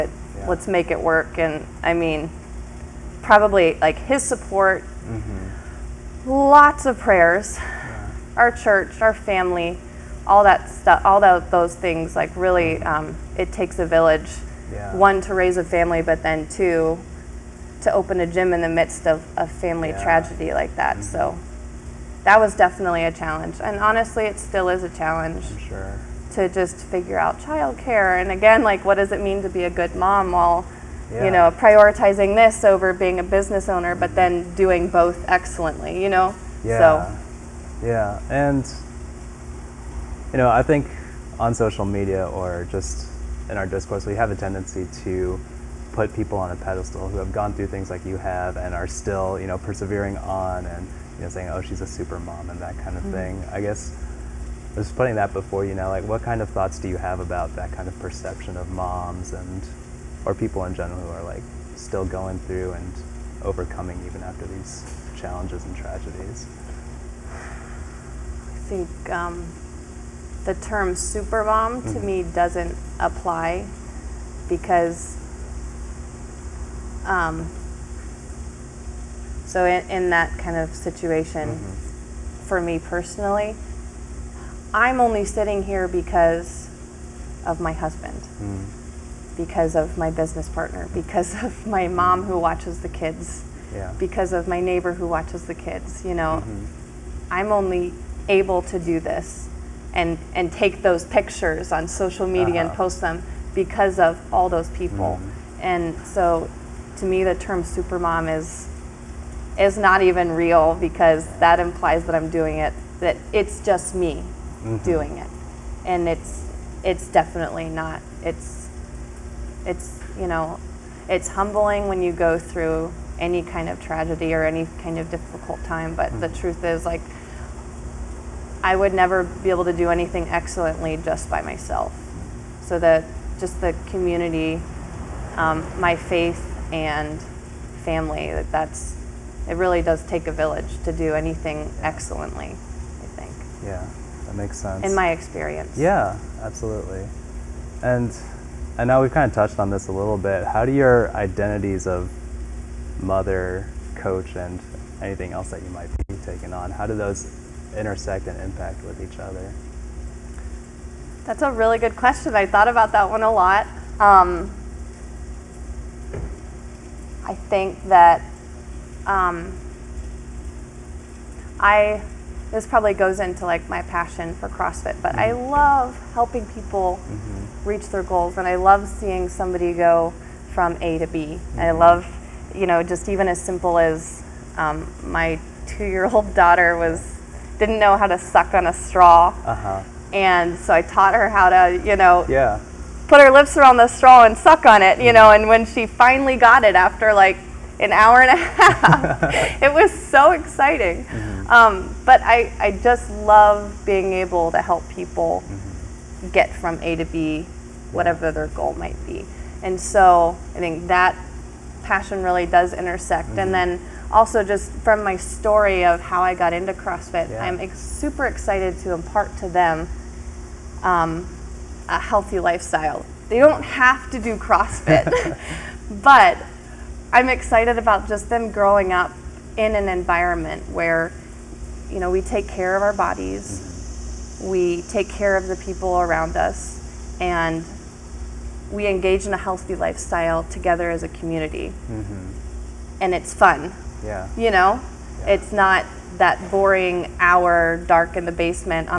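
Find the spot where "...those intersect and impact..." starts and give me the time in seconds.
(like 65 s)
156 s.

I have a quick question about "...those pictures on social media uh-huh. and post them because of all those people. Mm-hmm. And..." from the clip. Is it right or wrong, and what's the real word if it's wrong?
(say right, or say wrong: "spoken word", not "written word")
right.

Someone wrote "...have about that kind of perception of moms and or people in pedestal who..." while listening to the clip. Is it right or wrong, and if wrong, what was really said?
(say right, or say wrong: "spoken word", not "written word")
wrong: "general", not "pedestal".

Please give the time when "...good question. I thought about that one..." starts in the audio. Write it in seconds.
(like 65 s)
161 s.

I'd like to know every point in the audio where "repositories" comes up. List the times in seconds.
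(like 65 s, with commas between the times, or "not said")
not said.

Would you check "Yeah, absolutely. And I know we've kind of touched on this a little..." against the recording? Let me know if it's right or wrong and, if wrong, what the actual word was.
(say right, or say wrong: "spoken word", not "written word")
right.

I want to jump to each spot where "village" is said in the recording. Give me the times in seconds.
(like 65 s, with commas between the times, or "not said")
13 s, 140 s.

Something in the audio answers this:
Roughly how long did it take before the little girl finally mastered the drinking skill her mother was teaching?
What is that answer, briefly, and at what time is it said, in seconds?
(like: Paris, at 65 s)
An hour and a half, at 197 s.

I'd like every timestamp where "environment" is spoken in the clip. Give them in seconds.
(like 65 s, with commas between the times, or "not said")
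229 s.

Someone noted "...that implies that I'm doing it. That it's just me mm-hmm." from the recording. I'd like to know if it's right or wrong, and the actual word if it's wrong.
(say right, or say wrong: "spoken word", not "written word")
right.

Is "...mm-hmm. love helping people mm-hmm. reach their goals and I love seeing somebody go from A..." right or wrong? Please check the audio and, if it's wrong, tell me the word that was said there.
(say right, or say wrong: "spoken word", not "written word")
right.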